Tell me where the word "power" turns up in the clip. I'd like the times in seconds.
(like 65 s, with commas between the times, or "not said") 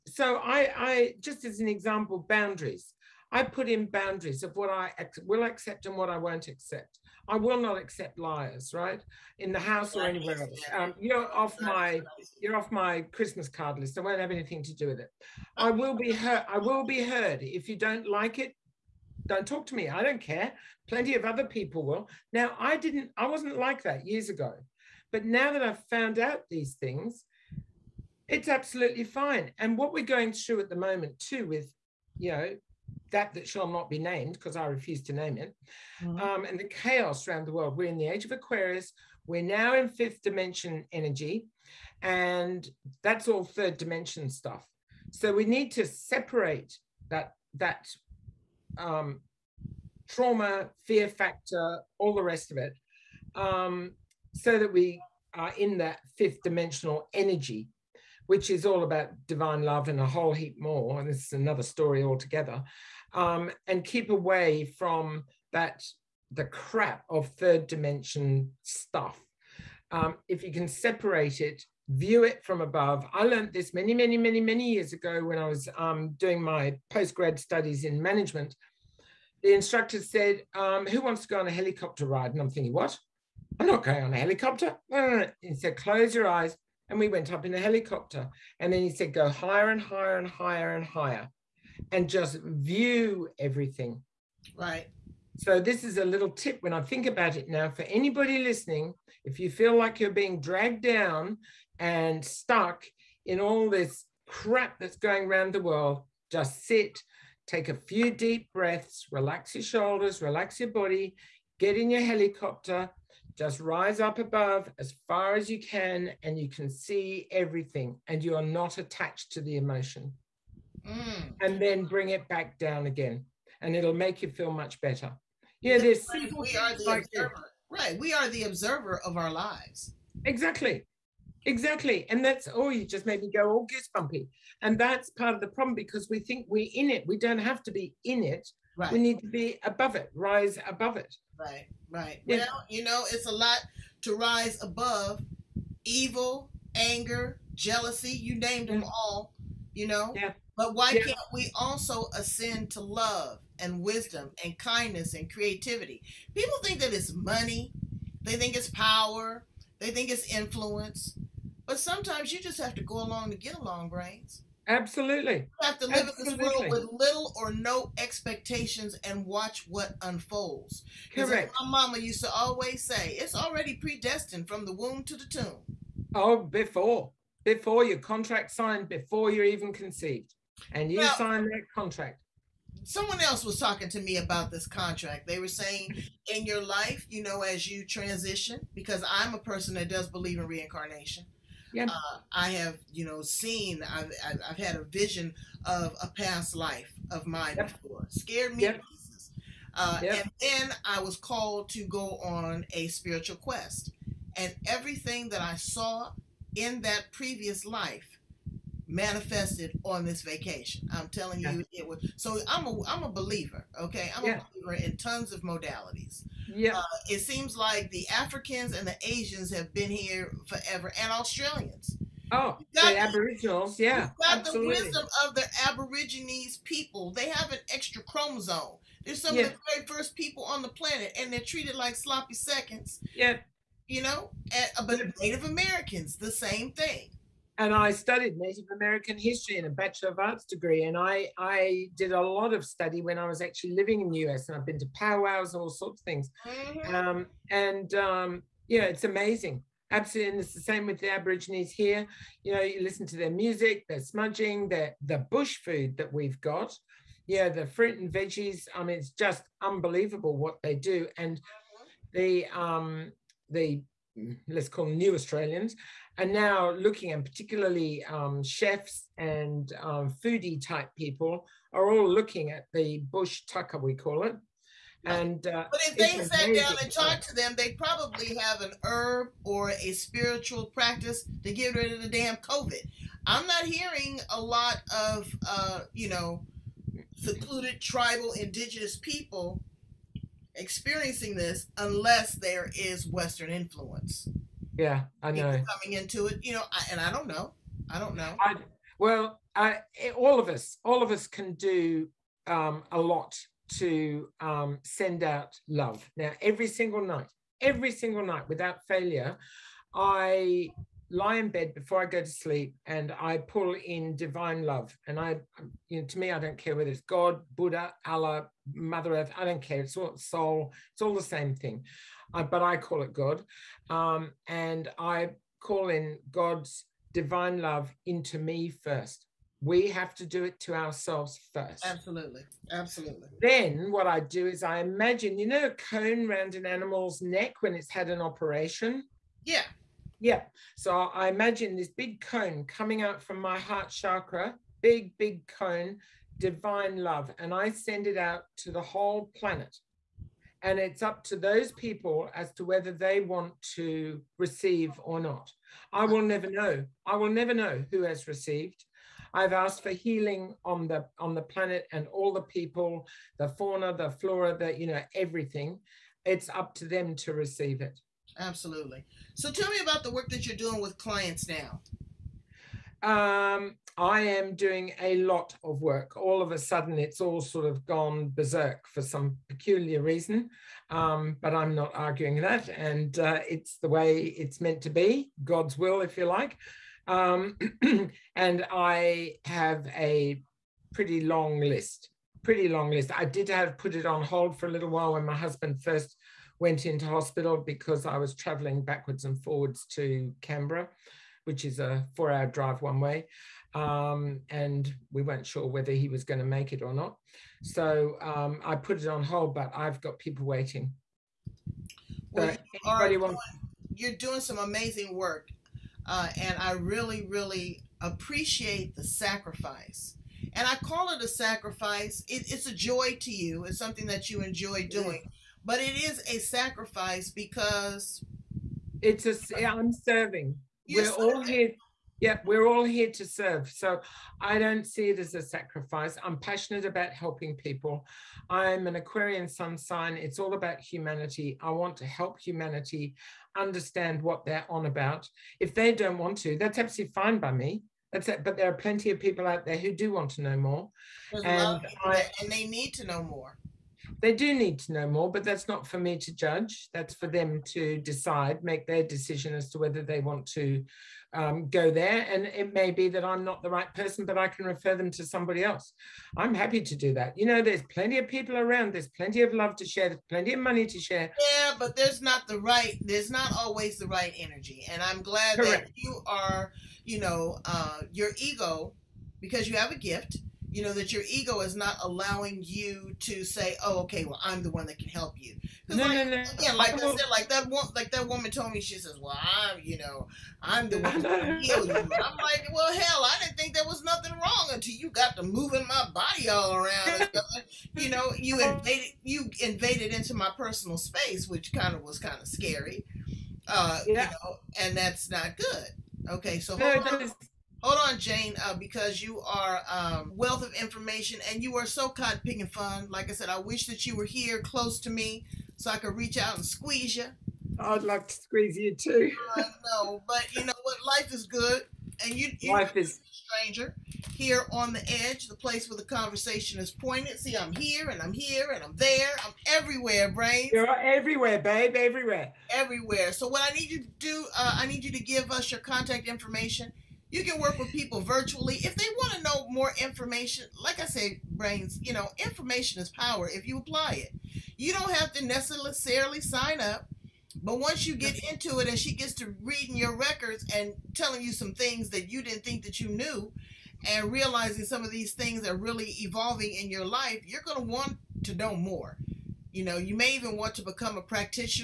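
158 s, 543 s.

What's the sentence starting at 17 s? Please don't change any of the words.
If you don't like it, don't talk to me.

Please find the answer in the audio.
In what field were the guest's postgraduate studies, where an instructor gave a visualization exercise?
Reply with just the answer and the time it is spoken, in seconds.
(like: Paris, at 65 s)
Management, at 78 s.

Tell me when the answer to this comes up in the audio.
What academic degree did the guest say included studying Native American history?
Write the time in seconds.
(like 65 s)
239 s.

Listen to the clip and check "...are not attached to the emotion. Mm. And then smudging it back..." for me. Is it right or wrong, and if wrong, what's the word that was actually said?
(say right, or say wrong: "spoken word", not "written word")
wrong: "bring", not "smudging".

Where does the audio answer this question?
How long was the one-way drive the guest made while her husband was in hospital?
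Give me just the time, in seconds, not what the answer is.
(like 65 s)
402 s.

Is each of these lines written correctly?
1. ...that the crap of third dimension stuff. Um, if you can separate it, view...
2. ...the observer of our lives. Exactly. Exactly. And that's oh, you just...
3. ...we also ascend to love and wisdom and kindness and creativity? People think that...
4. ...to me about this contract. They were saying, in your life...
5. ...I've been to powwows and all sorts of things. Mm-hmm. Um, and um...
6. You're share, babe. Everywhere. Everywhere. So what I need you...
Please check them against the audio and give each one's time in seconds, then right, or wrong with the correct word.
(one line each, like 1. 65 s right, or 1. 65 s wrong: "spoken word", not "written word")
1. 65 s right
2. 128 s right
3. 151 s right
4. 183 s right
5. 244 s right
6. 530 s wrong: "everywhere", not "share".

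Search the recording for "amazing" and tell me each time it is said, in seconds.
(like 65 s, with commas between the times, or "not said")
249 s, 414 s.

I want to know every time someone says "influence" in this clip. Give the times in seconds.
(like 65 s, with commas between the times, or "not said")
160 s, 293 s.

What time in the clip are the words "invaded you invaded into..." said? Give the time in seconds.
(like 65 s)
498 s.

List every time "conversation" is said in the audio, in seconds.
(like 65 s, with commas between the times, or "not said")
526 s.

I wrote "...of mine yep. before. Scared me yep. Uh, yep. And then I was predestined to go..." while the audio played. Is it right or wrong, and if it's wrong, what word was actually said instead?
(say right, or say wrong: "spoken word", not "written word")
wrong: "called", not "predestined".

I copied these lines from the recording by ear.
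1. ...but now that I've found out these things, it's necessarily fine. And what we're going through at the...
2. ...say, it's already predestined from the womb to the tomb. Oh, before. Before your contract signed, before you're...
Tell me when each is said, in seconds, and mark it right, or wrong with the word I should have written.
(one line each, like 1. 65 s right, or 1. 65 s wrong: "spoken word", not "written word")
1. 25 s wrong: "absolutely", not "necessarily"
2. 172 s right.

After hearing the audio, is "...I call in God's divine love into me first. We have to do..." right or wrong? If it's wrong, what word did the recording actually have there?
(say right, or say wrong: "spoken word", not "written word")
right.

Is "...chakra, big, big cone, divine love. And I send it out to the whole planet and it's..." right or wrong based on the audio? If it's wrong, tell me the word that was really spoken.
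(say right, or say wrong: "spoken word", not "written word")
right.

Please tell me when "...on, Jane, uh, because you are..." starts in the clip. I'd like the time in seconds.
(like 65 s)
508 s.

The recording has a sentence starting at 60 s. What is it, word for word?
And this is another story altogether.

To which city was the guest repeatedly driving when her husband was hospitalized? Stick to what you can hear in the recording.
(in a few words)
Canberra.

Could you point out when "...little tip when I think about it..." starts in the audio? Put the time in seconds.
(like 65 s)
96 s.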